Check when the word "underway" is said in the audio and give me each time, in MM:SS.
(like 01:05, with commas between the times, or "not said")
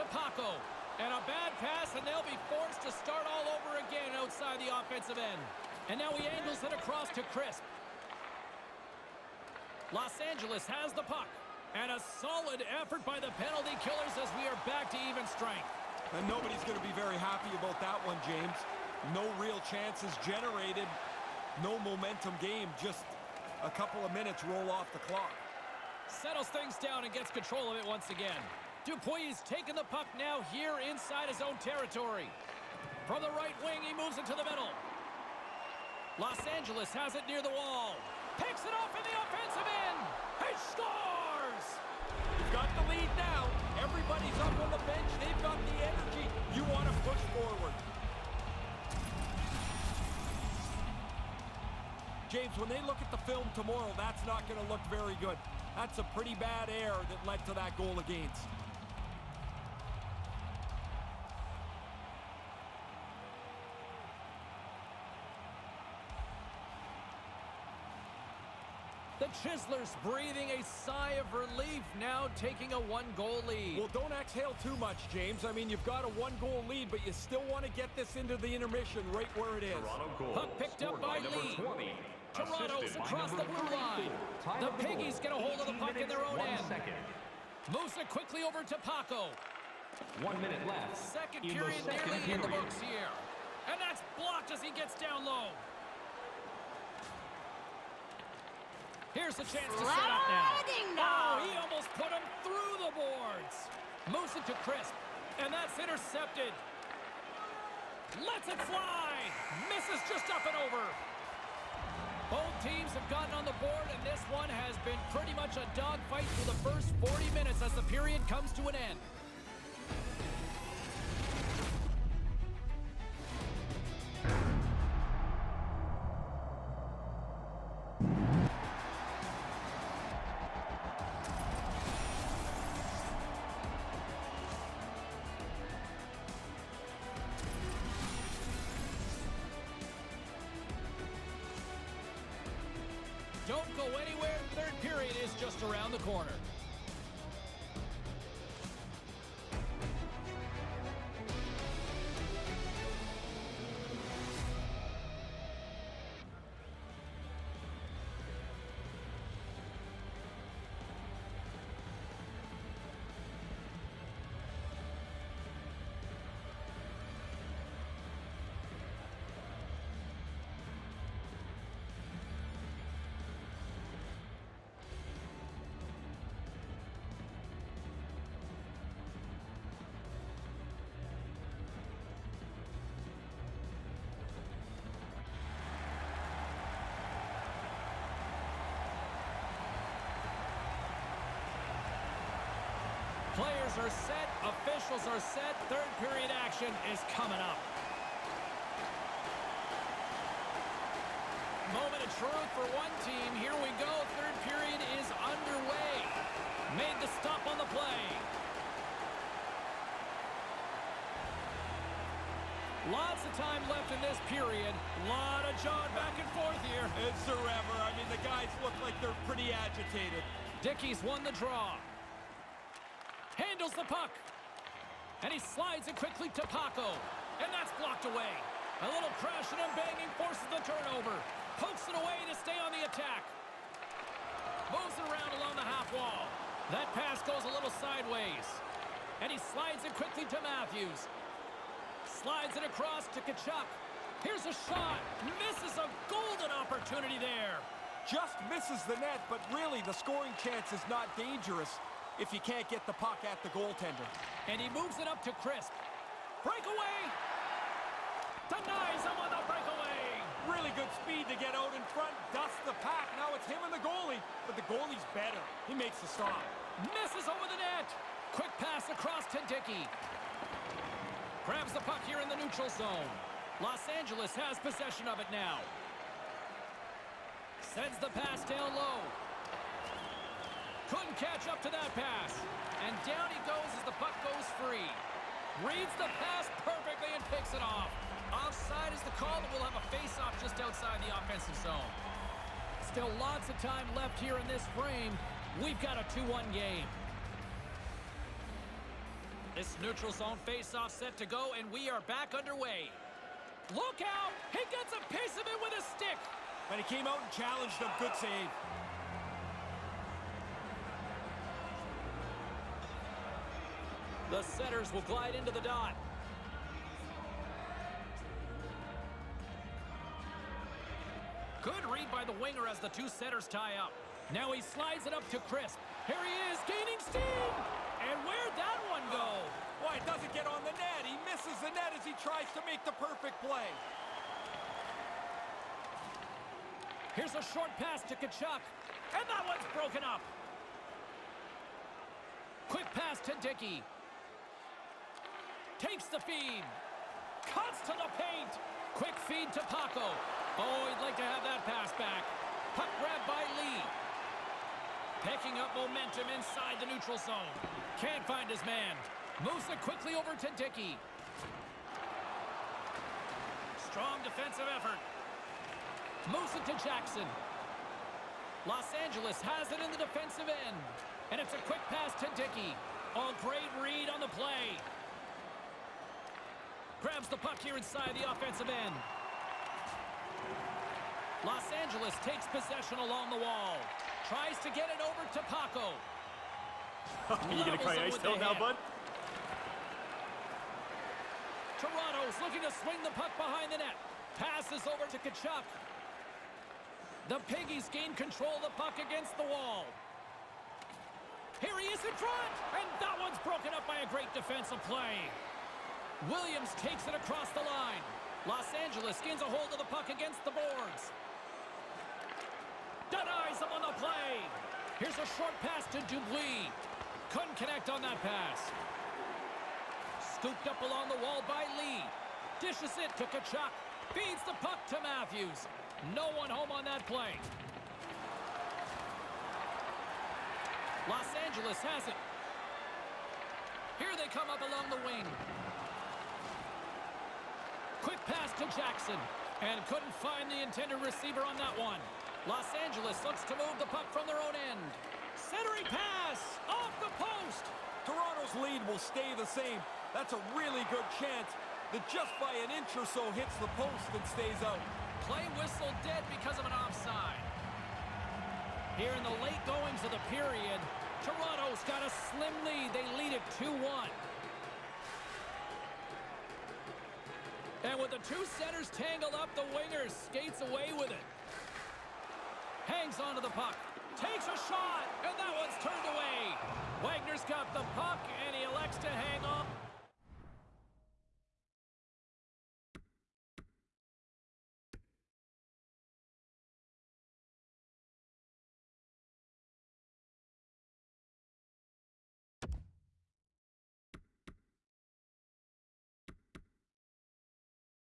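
03:25, 05:02.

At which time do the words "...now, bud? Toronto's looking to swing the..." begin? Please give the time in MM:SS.
06:28.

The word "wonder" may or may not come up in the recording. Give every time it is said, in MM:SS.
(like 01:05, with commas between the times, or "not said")
not said.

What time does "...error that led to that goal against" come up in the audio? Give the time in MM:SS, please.
00:56.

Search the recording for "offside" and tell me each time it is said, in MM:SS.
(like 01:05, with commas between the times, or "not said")
04:48, 07:36.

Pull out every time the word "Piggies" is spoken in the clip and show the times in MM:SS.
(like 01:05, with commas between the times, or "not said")
01:24, 06:37.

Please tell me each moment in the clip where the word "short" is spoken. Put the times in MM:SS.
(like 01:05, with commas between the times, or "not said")
05:37, 06:55.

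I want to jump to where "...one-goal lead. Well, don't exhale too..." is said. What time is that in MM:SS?
01:12.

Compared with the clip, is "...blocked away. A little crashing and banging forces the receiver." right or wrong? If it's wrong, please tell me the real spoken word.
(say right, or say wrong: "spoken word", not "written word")
wrong: "turnover", not "receiver".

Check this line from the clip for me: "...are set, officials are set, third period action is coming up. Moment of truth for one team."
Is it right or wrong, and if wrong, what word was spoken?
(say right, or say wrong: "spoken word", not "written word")
right.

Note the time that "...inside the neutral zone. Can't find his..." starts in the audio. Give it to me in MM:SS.
05:56.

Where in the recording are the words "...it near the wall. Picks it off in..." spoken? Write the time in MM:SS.
00:37.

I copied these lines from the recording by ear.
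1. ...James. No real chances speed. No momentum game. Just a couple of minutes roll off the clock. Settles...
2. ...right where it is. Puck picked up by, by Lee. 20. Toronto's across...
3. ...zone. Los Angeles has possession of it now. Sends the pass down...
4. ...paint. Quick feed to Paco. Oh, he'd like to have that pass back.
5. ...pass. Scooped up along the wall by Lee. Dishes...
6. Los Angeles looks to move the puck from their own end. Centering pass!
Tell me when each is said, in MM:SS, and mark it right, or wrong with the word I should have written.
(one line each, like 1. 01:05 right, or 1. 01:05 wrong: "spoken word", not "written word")
1. 00:18 wrong: "generated", not "speed"
2. 01:19 right
3. 04:32 right
4. 05:48 right
5. 06:58 right
6. 07:22 right.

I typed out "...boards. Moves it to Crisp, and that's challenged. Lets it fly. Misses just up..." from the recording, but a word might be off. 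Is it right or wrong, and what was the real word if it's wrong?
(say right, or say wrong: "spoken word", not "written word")
wrong: "intercepted", not "challenged".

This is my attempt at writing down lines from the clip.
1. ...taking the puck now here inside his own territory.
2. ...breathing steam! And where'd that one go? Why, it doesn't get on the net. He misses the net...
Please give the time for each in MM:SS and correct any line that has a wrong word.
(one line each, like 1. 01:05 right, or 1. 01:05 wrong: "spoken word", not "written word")
1. 00:29 right
2. 05:26 wrong: "gaining", not "breathing".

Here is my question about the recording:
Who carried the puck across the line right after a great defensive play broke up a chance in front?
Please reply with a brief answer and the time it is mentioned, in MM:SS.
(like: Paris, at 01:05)
Williams, at 06:46.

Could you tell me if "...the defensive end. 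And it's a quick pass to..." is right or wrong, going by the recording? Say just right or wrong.
right.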